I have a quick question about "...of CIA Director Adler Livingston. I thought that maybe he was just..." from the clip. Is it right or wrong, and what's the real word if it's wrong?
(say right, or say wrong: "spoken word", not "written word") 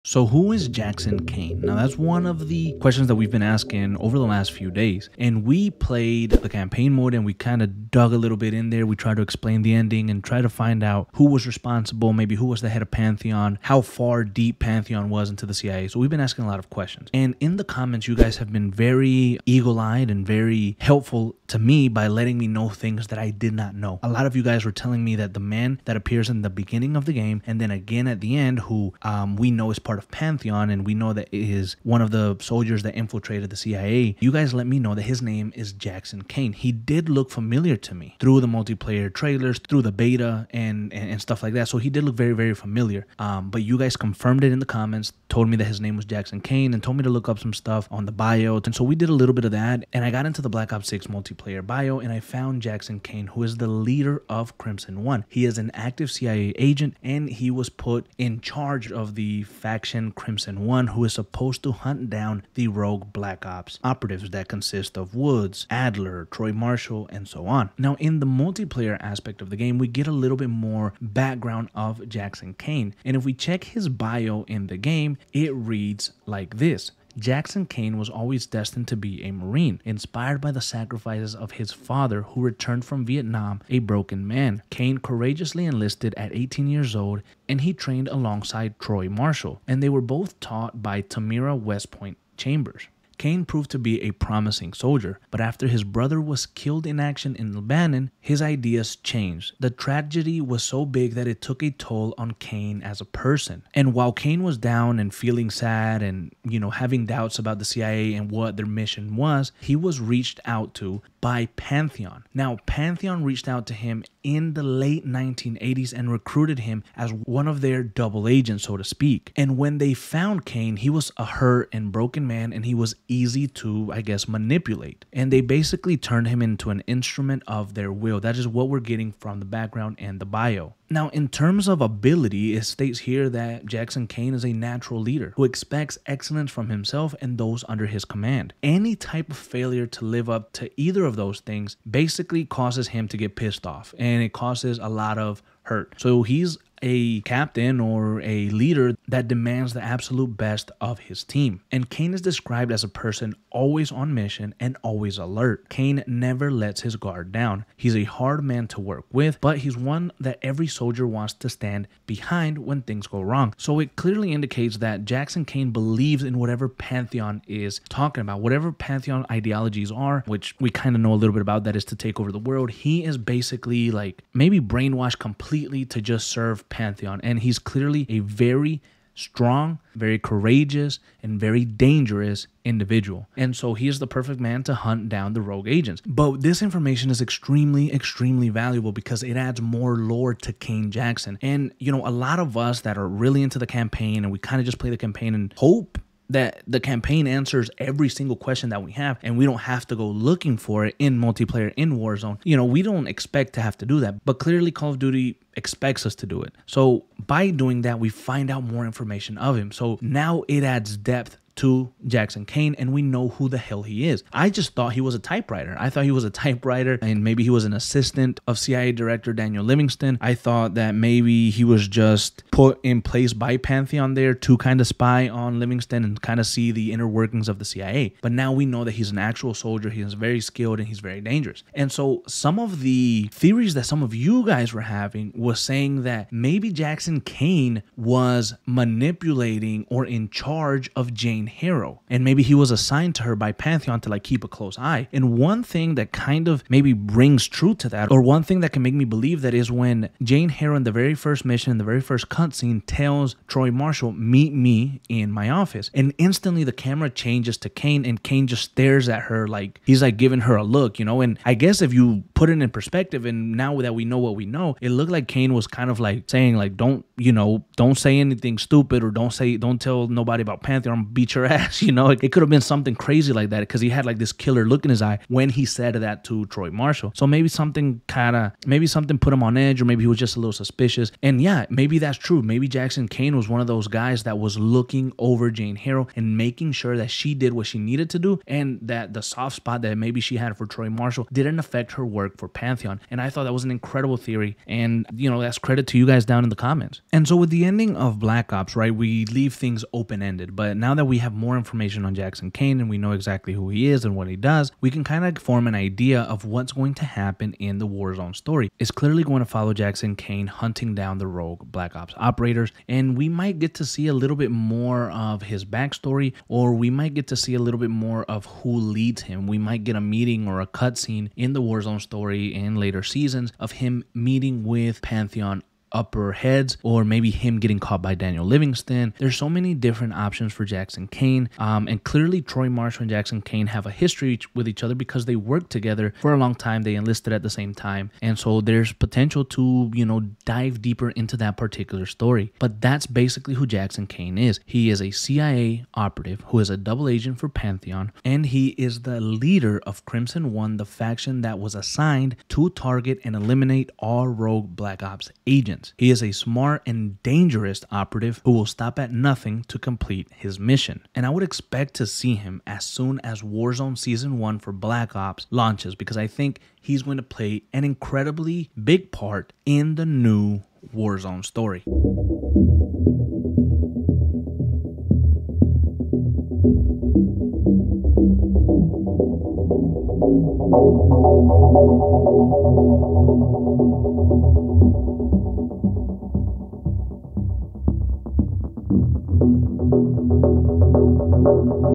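wrong: "Daniel", not "Adler".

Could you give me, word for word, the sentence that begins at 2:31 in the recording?
And Caine is described as a person always on mission and always alert.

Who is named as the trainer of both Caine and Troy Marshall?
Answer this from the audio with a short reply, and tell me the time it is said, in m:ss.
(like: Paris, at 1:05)
Tamira West Point Chambers, at 1:31.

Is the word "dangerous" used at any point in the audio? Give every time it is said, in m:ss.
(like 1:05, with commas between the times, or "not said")
3:01, 3:51, 5:57.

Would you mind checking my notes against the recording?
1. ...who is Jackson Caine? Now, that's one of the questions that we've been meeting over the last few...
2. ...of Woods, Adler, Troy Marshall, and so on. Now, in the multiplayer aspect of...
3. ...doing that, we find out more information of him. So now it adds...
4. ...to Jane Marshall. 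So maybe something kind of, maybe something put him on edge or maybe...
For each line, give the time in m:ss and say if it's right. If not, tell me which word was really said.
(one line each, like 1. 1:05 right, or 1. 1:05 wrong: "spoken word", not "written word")
1. 0:00 wrong: "asking", not "meeting"
2. 1:04 right
3. 3:27 right
4. 4:36 wrong: "Troy", not "Jane".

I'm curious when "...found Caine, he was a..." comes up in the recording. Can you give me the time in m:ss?
1:59.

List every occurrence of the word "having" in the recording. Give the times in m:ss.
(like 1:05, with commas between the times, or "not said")
1:46, 3:54.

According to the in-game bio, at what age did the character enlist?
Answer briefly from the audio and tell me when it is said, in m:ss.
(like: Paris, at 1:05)
18, at 1:26.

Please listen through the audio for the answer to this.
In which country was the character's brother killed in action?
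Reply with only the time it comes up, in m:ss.
1:37.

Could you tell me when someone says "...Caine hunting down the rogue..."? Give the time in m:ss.
5:10.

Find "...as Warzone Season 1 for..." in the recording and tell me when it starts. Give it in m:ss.
6:03.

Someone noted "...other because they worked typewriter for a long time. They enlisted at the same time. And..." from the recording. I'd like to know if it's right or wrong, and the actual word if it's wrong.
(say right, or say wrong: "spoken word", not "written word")
wrong: "together", not "typewriter".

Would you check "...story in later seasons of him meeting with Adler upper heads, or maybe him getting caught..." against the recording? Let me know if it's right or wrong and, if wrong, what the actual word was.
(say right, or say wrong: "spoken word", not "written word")
wrong: "Pantheon", not "Adler".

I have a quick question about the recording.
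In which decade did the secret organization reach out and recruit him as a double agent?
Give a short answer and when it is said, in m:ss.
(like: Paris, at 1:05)
late 1980s, at 1:54.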